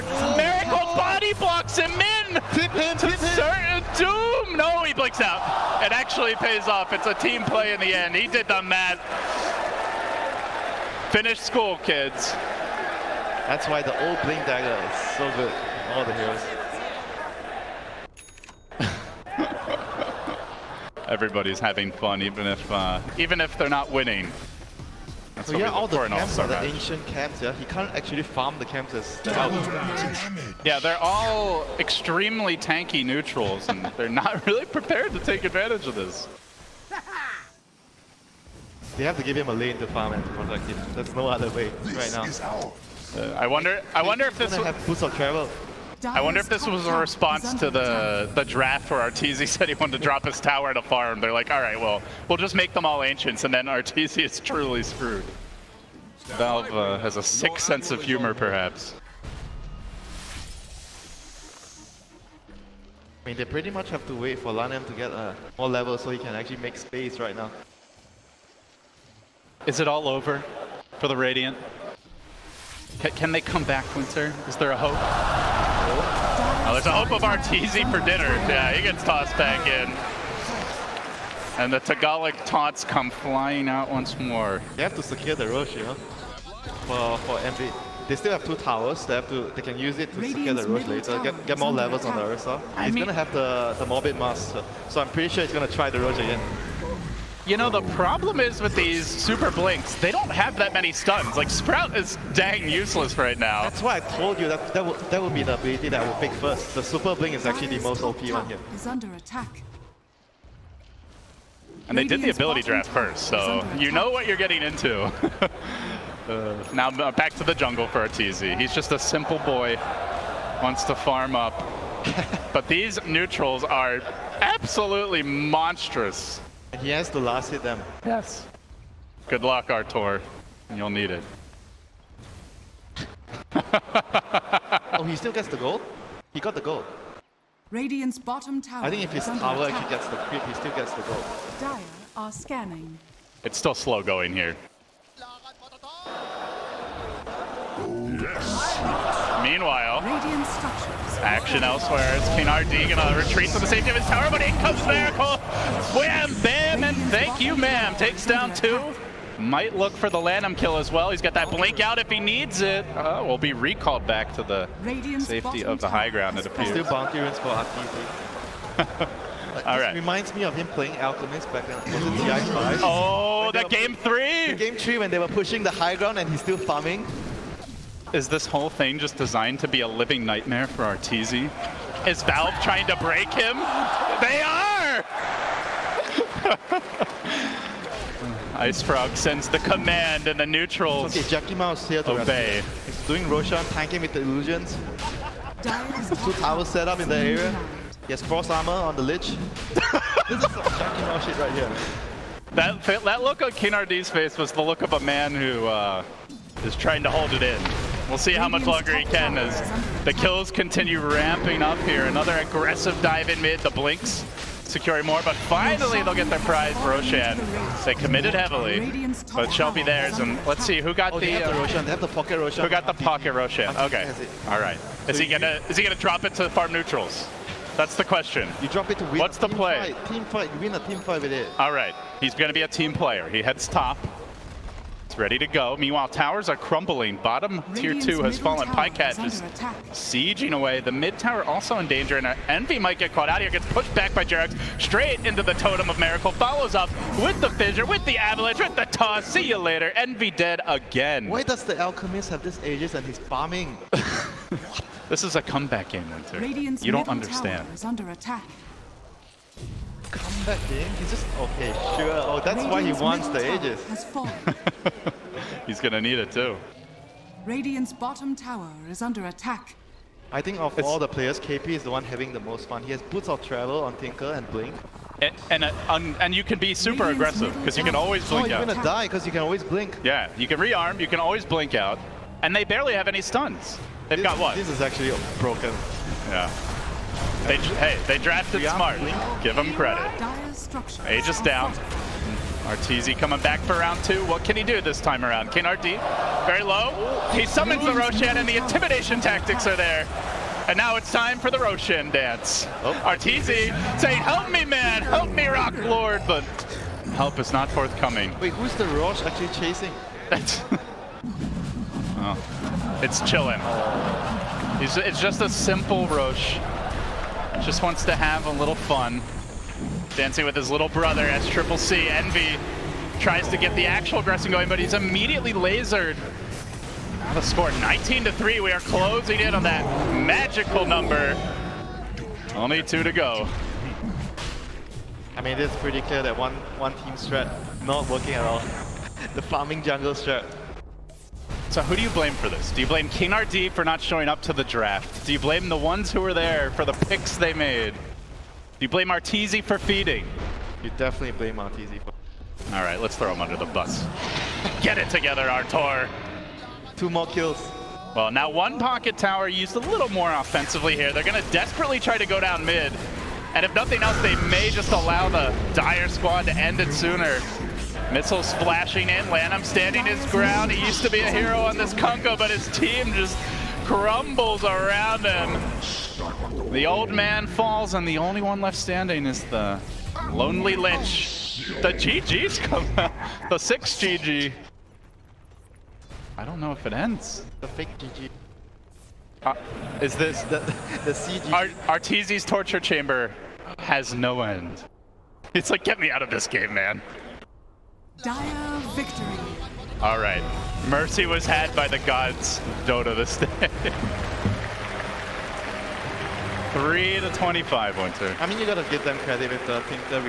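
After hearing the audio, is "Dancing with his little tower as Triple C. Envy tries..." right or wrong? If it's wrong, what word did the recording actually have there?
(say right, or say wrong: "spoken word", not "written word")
wrong: "brother", not "tower".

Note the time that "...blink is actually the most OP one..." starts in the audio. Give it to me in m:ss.
1:47.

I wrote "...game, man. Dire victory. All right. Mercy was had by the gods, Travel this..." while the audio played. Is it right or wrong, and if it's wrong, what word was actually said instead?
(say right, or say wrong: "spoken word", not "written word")
wrong: "Dota", not "Travel".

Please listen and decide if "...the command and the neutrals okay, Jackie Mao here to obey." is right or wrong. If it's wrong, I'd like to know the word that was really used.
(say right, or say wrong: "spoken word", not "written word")
right.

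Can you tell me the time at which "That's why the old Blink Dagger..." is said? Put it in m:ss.
0:13.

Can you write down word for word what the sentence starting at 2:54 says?
Game three when they were pushing the high ground and he's still farming.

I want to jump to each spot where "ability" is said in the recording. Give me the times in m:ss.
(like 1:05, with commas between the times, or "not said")
1:45, 1:52.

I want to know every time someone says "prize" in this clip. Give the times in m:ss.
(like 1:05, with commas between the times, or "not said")
3:36.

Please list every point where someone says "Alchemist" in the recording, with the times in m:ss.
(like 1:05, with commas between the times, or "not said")
2:50, 4:11.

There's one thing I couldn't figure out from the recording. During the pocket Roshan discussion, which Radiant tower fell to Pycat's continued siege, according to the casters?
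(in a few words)
Bottom tier 2.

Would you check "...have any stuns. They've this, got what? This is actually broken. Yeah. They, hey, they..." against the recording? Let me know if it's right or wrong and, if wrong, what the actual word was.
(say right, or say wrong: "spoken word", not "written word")
right.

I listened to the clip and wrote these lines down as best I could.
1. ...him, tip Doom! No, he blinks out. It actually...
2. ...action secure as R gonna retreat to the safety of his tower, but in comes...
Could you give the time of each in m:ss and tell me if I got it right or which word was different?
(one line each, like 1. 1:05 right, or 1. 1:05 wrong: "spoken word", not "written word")
1. 0:02 right
2. 2:31 wrong: "elsewhere", not "secure".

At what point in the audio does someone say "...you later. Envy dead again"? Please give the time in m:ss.
4:09.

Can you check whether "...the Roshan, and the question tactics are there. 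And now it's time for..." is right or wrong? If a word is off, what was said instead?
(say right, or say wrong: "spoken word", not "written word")
wrong: "intimidation", not "question".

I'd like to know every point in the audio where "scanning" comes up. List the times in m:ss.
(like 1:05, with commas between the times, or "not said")
2:22.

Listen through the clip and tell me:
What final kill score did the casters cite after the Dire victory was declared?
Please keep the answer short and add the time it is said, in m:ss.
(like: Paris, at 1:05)
3 to 25, at 6:46.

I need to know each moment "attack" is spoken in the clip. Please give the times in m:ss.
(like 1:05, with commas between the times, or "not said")
1:49, 4:29.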